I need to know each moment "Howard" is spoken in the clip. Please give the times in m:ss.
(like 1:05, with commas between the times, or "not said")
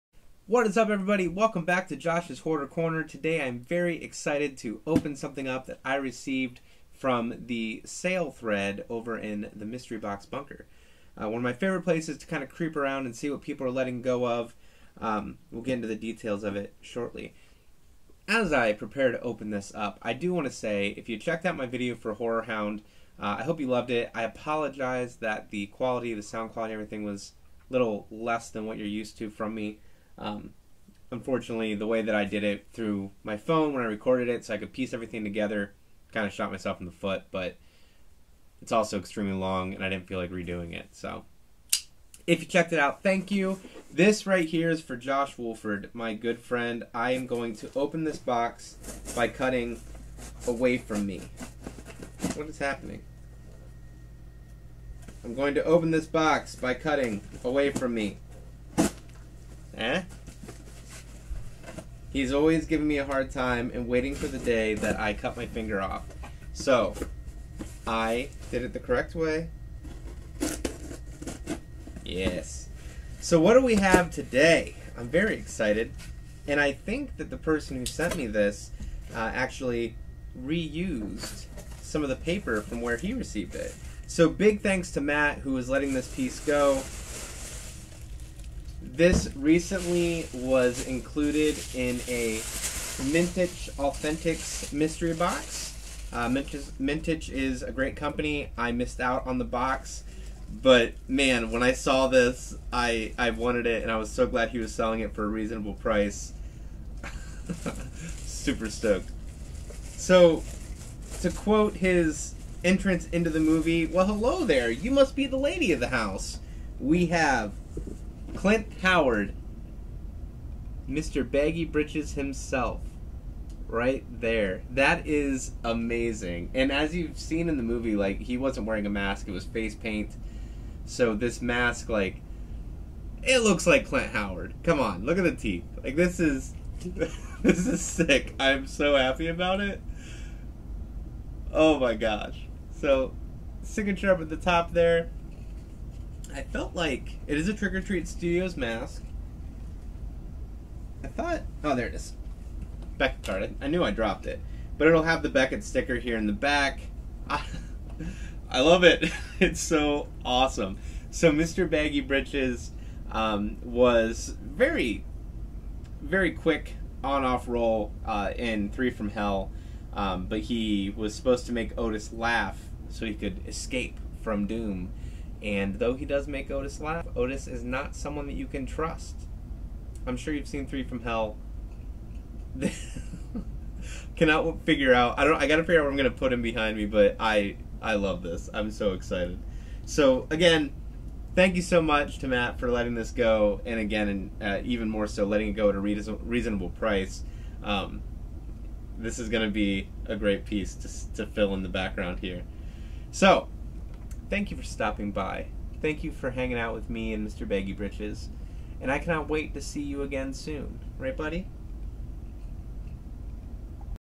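1:58, 2:14.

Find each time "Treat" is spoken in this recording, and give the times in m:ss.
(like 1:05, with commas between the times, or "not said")
2:27.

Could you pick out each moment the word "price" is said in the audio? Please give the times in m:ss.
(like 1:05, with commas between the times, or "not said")
1:45, 3:16.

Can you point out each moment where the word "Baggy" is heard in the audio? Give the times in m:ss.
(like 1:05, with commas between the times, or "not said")
2:01, 2:41, 3:27.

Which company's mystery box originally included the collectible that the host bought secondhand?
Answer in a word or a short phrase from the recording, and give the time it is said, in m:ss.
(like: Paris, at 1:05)
Mintych Authentics, at 1:33.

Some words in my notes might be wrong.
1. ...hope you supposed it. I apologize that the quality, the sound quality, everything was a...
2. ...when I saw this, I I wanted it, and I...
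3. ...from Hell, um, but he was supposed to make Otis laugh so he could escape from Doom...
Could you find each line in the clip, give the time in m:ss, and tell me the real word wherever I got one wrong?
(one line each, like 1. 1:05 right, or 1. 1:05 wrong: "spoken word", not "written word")
1. 0:23 wrong: "loved", not "supposed"
2. 1:41 right
3. 2:48 right.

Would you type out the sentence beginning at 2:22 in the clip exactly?
So signature up at the top there.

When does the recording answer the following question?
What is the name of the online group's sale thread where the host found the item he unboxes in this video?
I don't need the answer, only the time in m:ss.
0:09.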